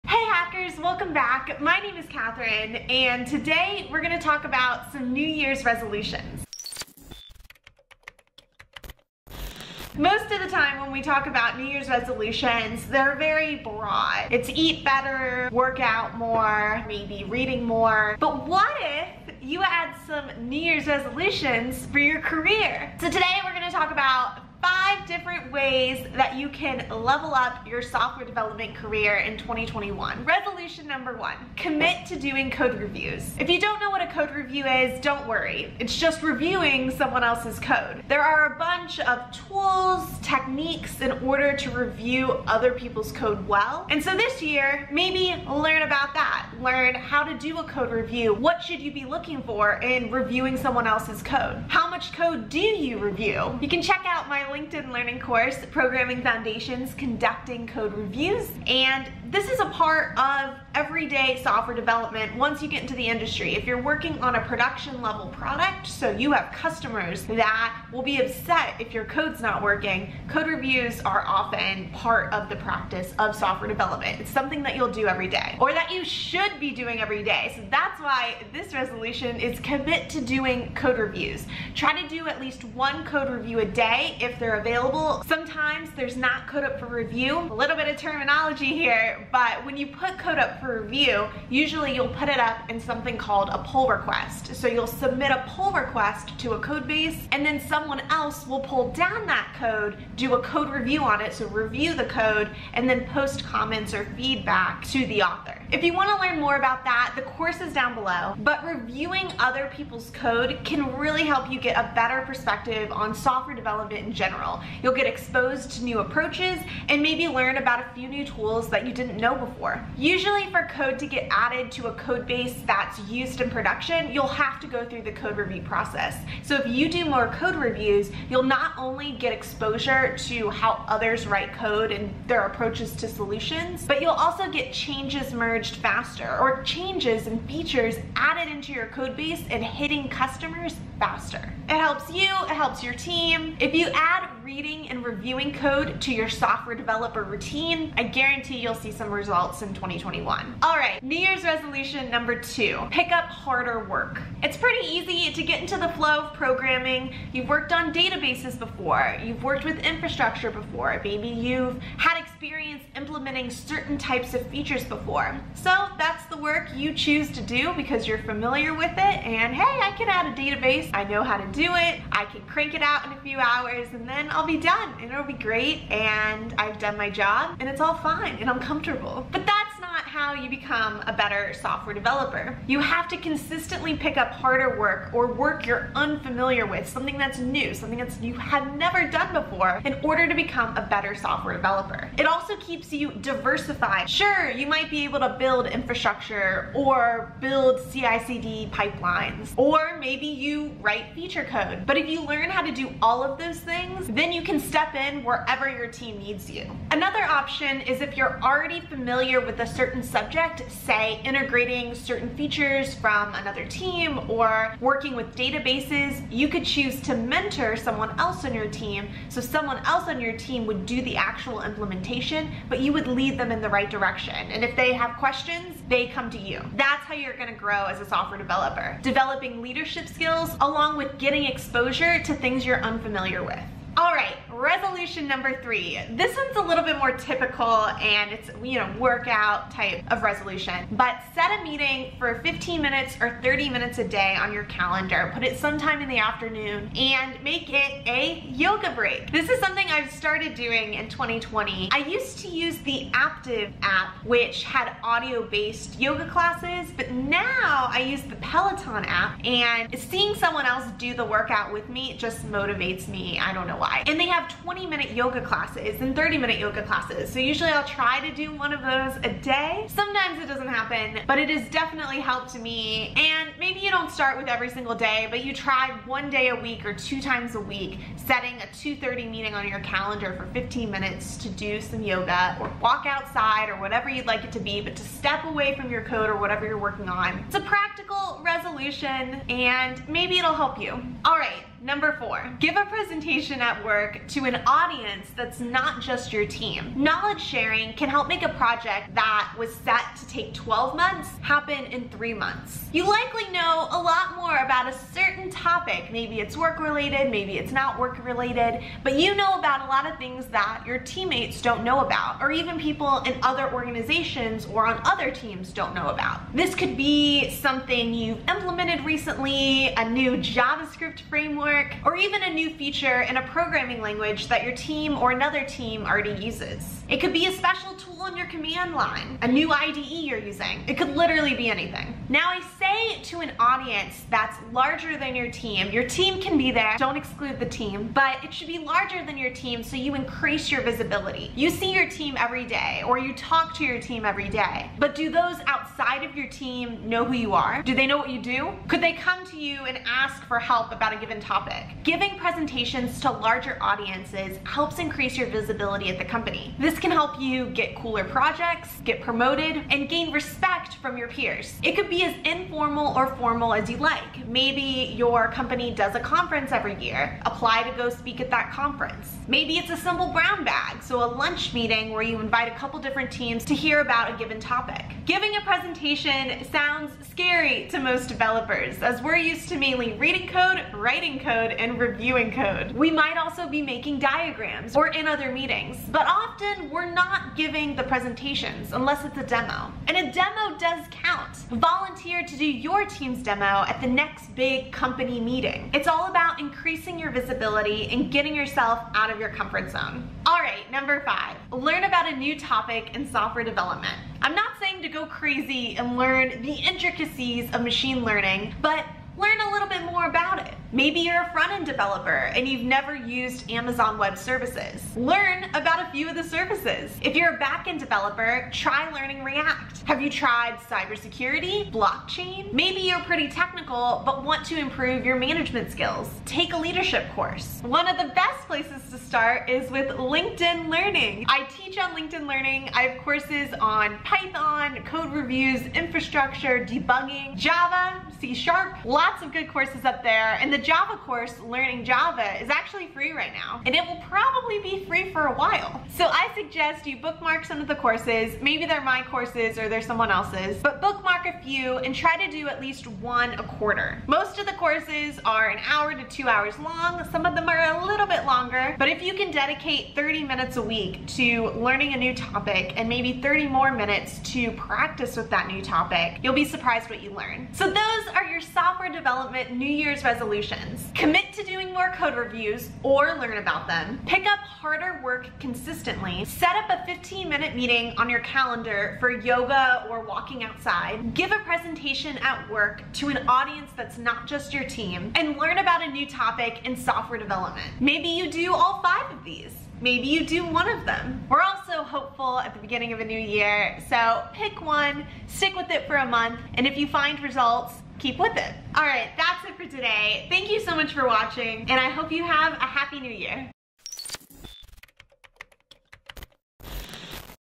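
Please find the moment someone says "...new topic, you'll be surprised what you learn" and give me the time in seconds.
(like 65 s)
465 s.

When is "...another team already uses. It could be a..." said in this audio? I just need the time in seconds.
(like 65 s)
325 s.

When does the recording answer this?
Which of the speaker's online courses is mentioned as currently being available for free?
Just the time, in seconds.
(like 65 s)
441 s.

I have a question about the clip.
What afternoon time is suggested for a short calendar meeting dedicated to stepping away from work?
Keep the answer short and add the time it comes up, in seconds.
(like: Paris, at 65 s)
2:30, at 278 s.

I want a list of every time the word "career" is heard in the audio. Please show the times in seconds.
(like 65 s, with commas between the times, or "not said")
22 s, 28 s.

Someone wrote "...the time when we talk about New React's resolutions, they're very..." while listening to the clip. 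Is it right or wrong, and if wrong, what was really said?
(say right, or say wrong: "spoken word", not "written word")
wrong: "Year", not "React".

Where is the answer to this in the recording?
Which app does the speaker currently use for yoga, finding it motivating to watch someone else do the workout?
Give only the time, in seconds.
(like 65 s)
258 s.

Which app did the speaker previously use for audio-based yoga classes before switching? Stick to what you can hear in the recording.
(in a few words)
Aaptiv.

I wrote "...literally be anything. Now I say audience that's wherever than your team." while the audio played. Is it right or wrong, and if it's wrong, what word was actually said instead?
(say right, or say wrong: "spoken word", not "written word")
wrong: "larger", not "wherever".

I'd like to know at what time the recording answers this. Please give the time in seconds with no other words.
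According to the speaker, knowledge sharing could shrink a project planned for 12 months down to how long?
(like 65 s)
302 s.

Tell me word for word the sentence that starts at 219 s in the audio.
So someone else on your team would do the actual implementation, but you would lead them in the right direction.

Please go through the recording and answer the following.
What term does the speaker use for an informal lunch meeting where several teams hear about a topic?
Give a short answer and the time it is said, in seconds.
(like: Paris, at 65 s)
brown bag, at 370 s.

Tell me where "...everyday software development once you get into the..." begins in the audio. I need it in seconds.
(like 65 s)
60 s.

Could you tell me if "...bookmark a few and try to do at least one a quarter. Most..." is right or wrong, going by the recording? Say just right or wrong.
right.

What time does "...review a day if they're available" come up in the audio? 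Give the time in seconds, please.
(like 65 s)
83 s.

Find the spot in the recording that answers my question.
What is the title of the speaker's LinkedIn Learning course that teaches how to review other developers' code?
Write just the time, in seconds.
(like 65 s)
55 s.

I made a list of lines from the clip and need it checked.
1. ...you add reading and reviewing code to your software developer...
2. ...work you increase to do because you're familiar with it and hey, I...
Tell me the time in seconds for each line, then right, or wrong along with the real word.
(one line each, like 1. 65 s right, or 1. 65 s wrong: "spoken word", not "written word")
1. 143 s right
2. 166 s wrong: "choose", not "increase".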